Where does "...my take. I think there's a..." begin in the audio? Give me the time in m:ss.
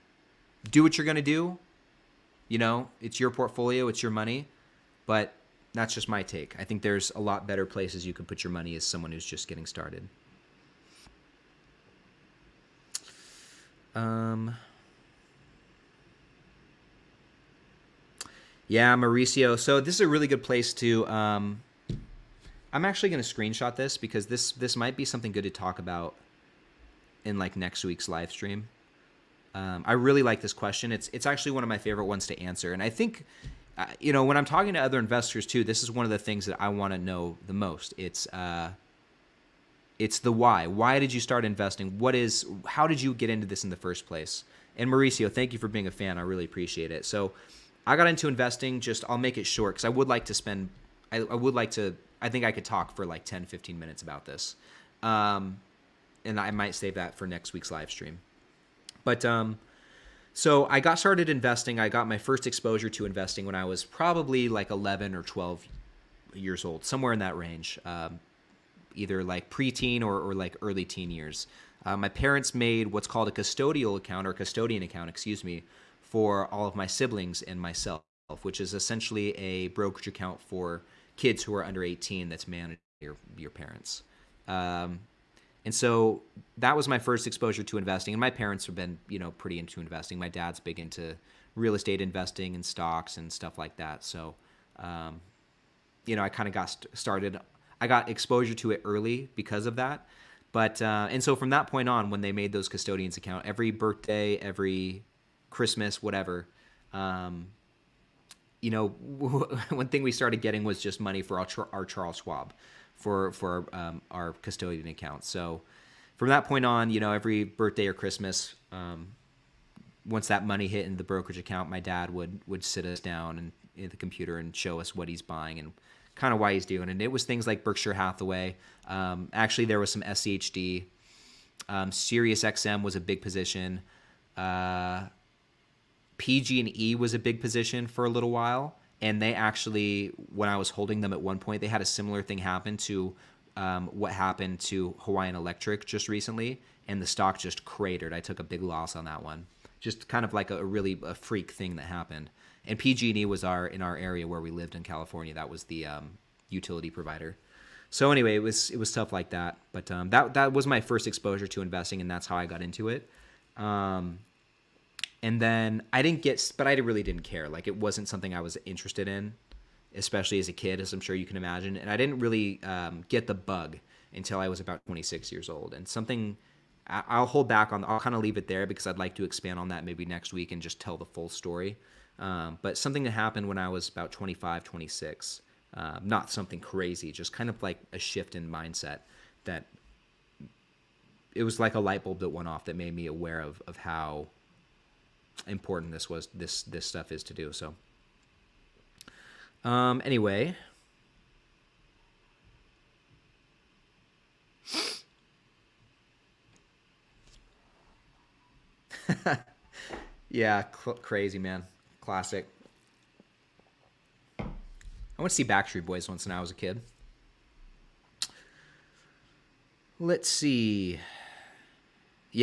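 0:06.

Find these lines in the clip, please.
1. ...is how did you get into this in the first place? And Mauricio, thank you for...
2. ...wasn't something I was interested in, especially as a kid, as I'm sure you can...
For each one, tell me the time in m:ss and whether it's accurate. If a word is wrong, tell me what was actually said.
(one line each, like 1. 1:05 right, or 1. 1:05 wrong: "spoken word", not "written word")
1. 0:42 right
2. 2:47 right.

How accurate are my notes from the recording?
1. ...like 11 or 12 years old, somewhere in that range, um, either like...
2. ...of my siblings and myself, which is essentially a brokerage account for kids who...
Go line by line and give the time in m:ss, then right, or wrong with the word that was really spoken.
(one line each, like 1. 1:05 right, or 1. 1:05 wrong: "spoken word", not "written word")
1. 1:04 right
2. 1:16 right.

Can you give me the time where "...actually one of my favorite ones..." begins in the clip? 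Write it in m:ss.
0:31.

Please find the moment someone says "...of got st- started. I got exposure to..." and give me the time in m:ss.
1:36.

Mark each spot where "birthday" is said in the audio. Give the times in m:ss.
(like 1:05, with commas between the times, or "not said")
1:43, 1:57.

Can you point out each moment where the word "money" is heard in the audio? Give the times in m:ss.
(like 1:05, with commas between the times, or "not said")
0:04, 0:08, 1:50, 2:00.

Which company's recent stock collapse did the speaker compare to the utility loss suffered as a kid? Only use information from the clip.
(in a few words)
Hawaiian Electric.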